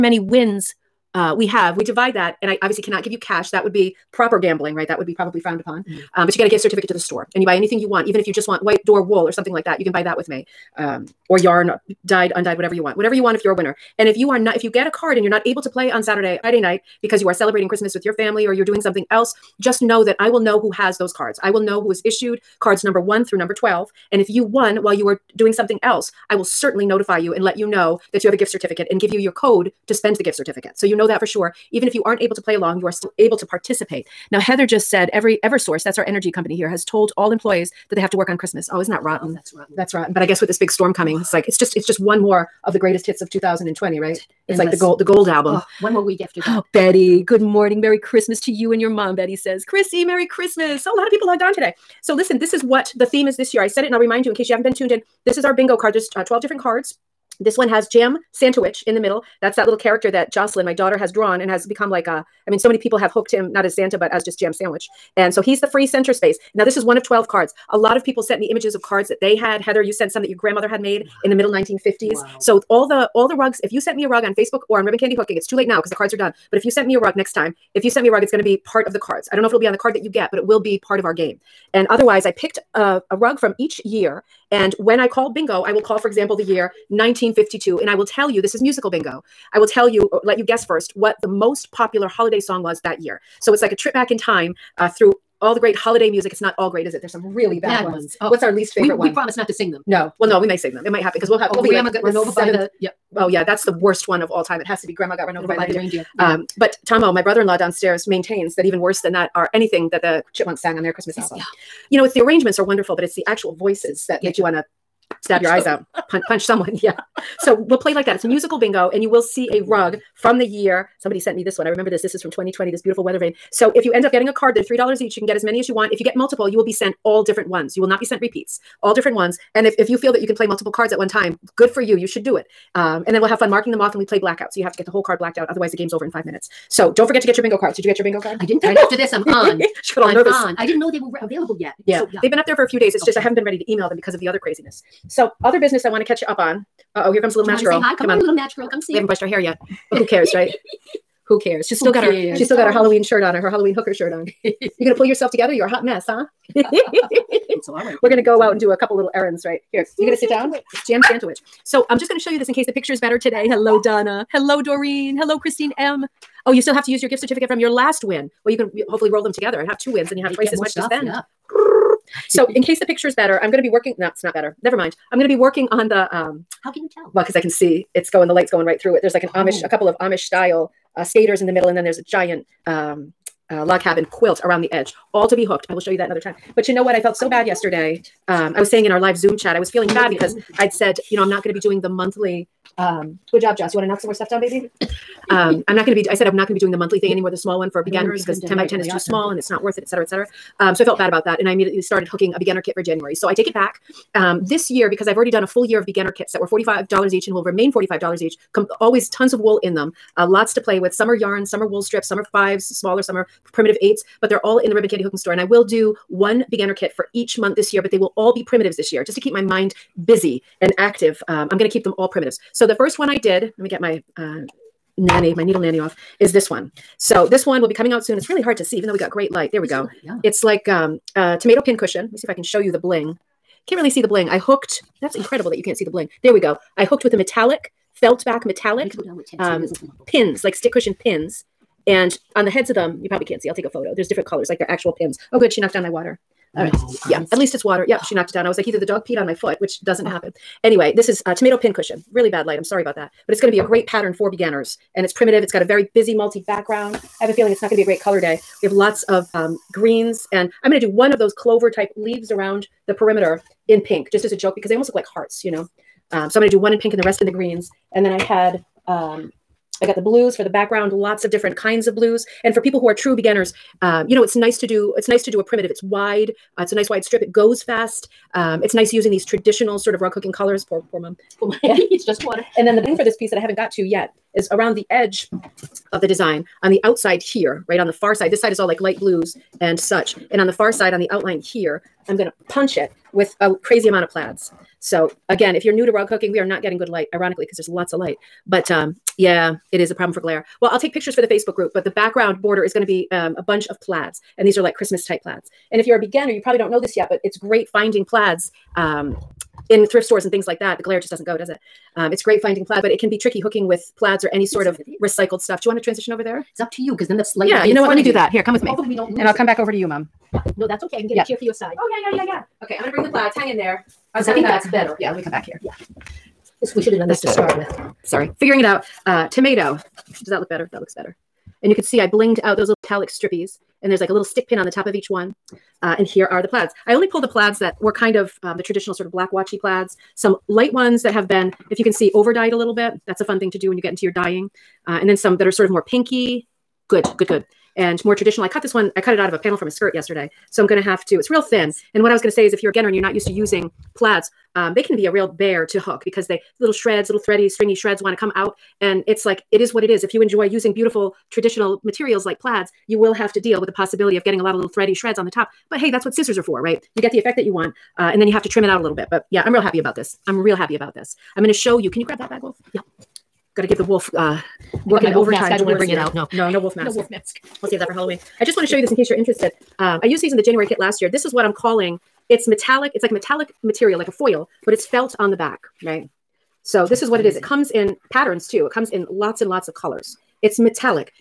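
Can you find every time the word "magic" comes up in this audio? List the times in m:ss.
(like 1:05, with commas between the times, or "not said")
not said.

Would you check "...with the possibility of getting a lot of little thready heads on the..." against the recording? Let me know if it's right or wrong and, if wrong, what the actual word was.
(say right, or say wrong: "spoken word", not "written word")
wrong: "shreds", not "heads".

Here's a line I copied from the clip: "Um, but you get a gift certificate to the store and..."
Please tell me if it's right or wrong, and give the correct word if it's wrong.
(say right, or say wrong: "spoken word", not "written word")
right.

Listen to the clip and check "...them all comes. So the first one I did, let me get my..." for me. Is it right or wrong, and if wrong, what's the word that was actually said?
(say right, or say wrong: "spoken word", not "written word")
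wrong: "primitives", not "comes".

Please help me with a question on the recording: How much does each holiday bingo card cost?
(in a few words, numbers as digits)
$3.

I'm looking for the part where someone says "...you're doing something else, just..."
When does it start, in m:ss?
0:18.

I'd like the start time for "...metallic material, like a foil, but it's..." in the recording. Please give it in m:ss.
6:23.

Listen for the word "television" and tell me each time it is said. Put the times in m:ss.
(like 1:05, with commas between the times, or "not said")
not said.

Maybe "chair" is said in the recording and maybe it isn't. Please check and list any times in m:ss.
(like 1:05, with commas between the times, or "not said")
5:21.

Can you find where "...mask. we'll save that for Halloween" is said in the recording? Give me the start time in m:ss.
6:17.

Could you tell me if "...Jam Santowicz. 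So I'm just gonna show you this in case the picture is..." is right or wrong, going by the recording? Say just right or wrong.
right.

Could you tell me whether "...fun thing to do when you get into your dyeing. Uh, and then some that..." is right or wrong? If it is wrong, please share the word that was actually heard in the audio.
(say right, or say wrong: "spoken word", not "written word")
right.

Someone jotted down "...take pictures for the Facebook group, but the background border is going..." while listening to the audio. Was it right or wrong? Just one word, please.
right.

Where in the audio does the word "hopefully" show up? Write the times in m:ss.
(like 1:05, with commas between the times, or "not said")
2:48, 5:18.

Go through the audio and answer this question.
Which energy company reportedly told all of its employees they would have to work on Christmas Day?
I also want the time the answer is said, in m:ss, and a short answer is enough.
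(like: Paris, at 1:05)
Eversource, at 0:35.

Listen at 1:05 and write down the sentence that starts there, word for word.
And so he's the free center space.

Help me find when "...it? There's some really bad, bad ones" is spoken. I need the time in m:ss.
1:36.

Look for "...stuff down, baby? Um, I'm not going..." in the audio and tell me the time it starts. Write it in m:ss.
3:14.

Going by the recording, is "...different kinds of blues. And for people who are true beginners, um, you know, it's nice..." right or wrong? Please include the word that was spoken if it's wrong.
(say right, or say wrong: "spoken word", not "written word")
right.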